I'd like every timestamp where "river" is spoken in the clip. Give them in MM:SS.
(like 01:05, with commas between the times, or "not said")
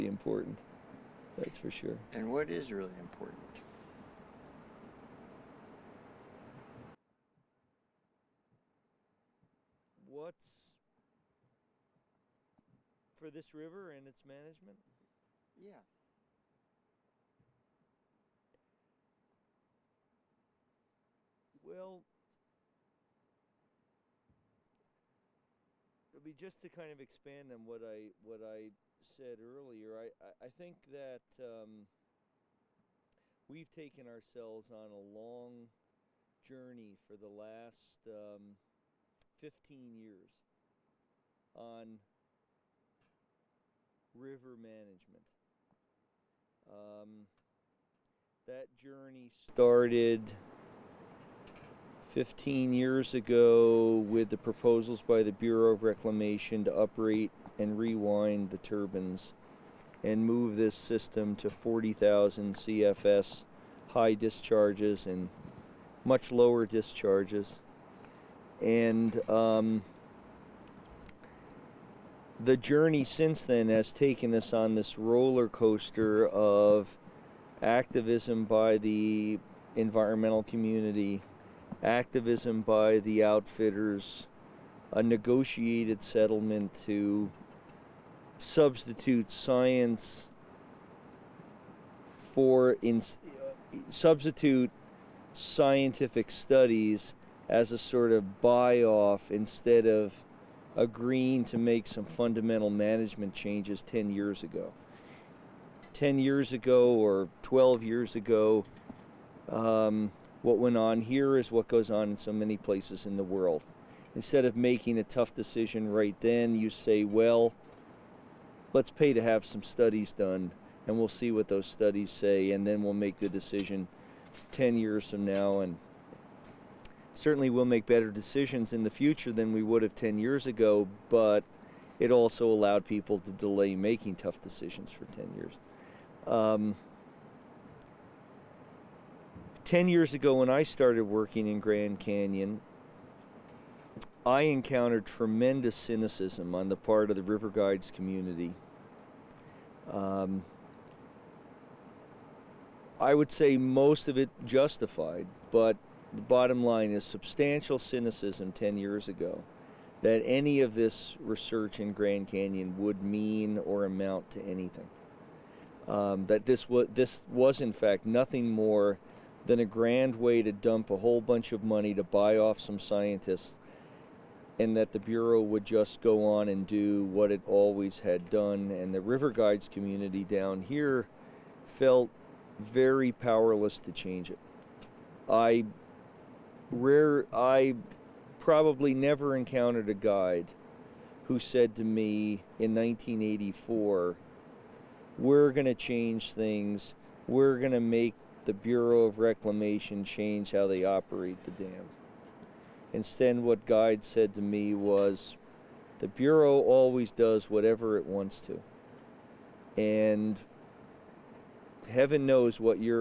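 00:13, 00:44, 02:27, 02:59.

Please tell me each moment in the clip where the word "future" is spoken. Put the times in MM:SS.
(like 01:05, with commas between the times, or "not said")
02:08.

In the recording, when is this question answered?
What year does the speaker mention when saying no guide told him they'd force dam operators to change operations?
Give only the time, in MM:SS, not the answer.
03:12.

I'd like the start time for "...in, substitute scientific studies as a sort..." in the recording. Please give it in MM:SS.
01:32.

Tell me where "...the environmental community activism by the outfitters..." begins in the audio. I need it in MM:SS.
01:18.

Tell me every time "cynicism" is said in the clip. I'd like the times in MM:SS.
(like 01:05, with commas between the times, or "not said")
02:25, 02:37.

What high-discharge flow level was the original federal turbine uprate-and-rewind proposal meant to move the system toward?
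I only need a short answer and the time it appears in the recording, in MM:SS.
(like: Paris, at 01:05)
40,000 CFS, at 01:01.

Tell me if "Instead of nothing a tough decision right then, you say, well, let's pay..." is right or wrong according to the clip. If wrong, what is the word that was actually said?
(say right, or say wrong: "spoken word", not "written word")
wrong: "making", not "nothing".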